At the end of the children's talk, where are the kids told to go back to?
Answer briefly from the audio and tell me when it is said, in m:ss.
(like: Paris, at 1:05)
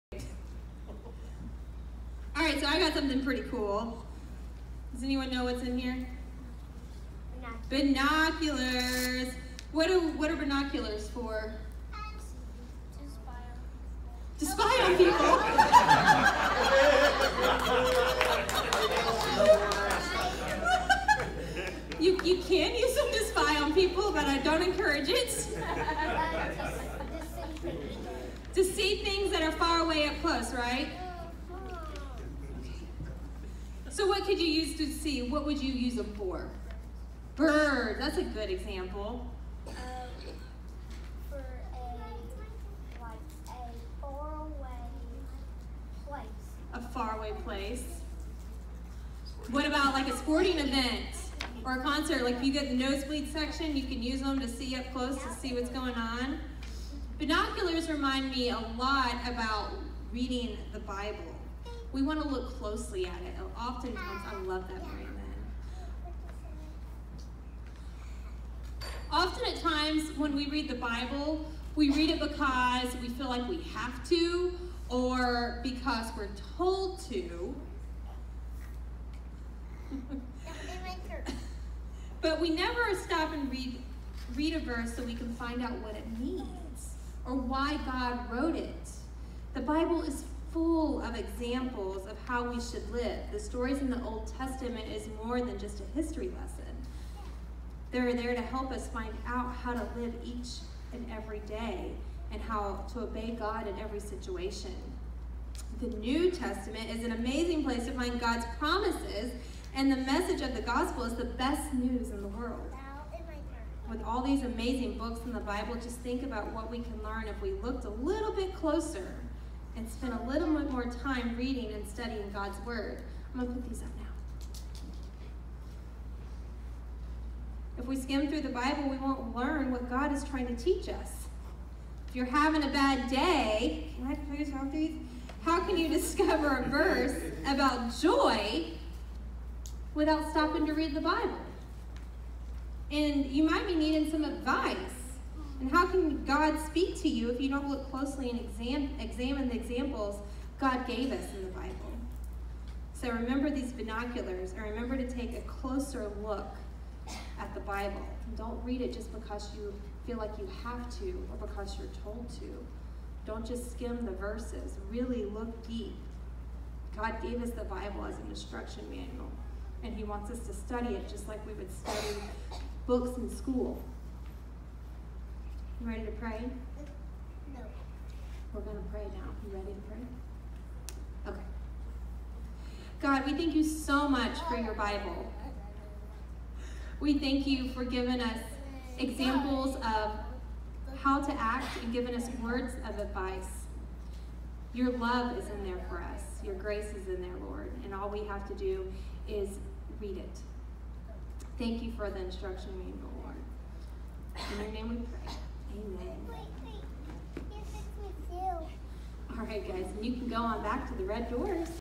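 The red doors, at 3:31.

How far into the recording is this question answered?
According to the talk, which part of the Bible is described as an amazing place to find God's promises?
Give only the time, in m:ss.
1:45.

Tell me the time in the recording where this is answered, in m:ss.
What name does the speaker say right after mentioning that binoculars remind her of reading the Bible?
1:04.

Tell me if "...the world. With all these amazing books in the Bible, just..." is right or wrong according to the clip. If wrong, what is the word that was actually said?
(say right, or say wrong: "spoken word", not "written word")
right.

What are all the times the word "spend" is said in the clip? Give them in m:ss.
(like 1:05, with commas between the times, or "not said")
1:59.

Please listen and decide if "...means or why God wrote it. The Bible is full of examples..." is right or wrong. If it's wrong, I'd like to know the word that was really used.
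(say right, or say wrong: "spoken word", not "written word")
right.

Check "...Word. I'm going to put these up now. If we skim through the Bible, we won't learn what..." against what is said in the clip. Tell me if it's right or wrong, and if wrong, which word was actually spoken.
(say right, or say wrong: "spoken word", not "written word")
right.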